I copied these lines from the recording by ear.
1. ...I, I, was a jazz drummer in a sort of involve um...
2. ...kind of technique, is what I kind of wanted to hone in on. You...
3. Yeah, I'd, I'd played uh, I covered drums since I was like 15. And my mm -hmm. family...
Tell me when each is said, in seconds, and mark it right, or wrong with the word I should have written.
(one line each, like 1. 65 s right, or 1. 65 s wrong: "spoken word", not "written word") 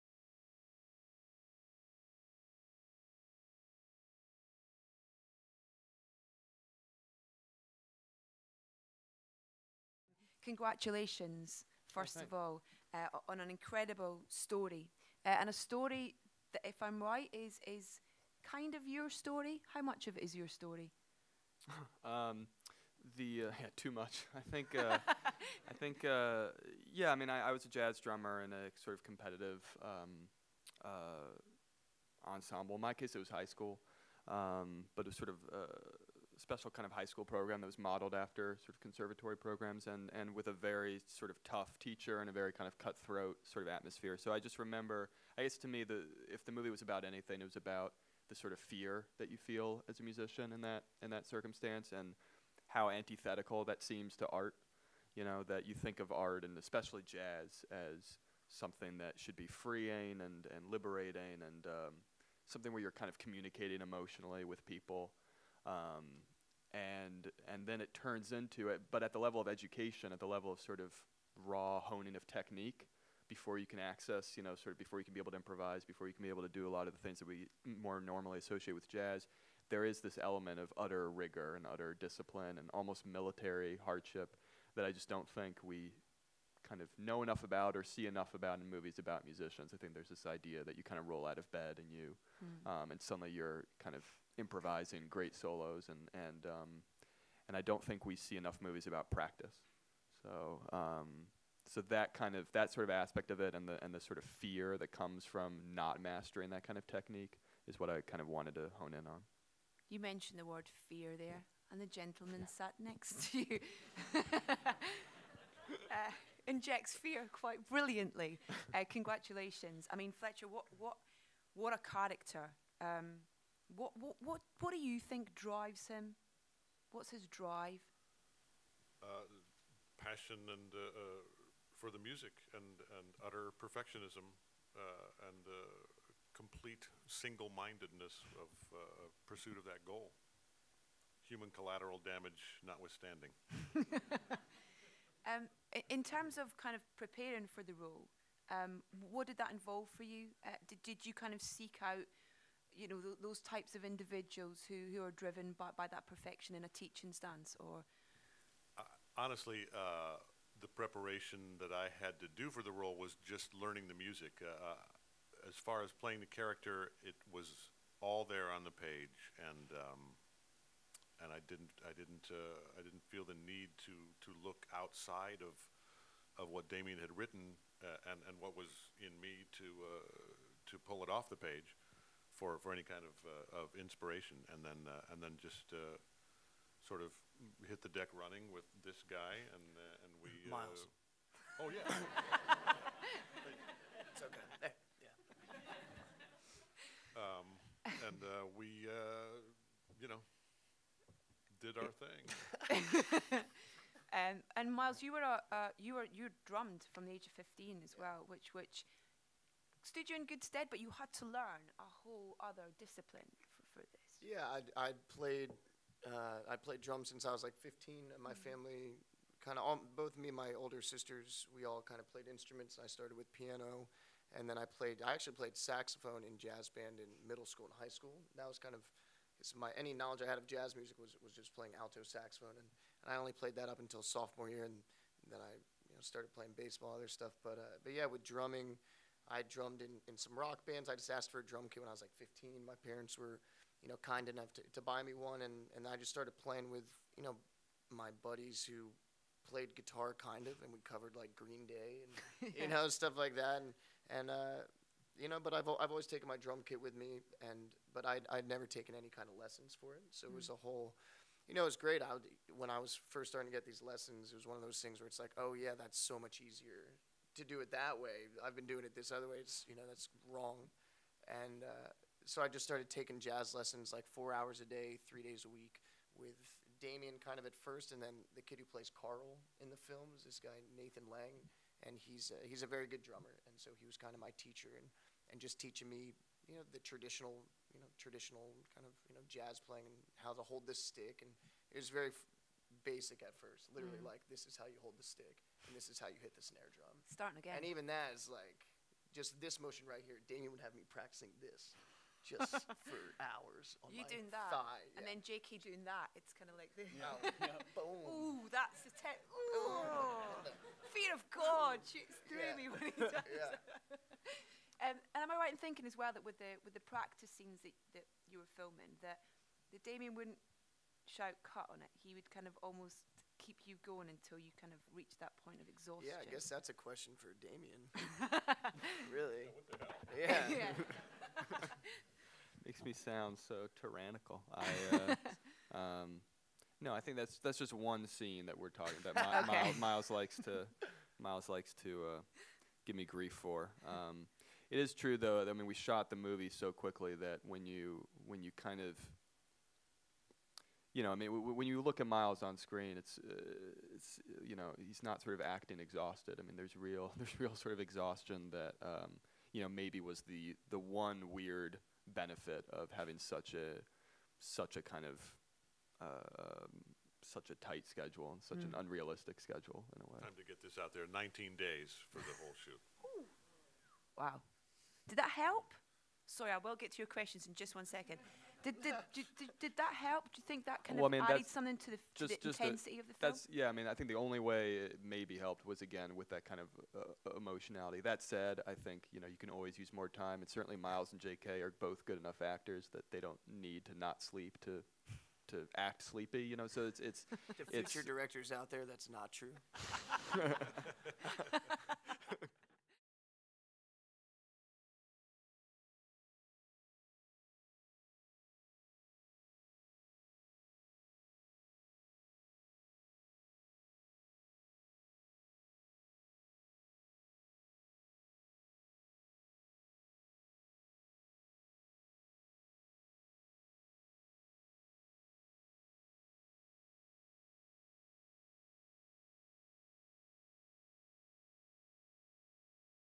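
1. 27 s wrong: "competitive", not "involve"
2. 106 s right
3. 214 s wrong: "played", not "covered".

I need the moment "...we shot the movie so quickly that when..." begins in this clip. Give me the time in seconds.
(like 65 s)
345 s.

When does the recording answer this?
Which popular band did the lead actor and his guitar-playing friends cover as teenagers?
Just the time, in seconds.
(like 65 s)
251 s.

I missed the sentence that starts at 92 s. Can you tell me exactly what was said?
um, and suddenly you're kind of improvising great solos, and and um, and I don't think we see enough movies about practice.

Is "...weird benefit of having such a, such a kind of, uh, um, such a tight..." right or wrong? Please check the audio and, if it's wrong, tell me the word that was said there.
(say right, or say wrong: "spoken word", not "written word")
right.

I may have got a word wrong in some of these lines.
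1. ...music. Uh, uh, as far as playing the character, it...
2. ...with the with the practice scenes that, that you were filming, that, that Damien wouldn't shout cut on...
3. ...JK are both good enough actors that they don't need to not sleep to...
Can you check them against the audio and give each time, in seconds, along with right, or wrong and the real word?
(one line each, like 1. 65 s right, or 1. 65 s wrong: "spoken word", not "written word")
1. 163 s right
2. 316 s right
3. 391 s right.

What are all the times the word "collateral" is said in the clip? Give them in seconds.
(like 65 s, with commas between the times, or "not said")
141 s.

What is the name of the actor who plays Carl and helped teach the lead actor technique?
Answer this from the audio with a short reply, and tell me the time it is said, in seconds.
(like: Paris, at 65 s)
Nathan Lang, at 280 s.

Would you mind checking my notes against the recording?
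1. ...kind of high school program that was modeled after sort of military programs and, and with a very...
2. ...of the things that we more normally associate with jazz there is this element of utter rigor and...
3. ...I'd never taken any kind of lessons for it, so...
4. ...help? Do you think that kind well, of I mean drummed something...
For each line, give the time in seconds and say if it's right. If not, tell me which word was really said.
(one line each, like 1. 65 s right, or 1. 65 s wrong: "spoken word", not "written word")
1. 36 s wrong: "conservatory", not "military"
2. 76 s right
3. 258 s right
4. 379 s wrong: "added", not "drummed".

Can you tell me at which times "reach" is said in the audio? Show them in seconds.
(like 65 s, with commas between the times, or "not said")
324 s.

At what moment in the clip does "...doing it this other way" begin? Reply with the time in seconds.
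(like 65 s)
268 s.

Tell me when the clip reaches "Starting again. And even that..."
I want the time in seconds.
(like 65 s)
297 s.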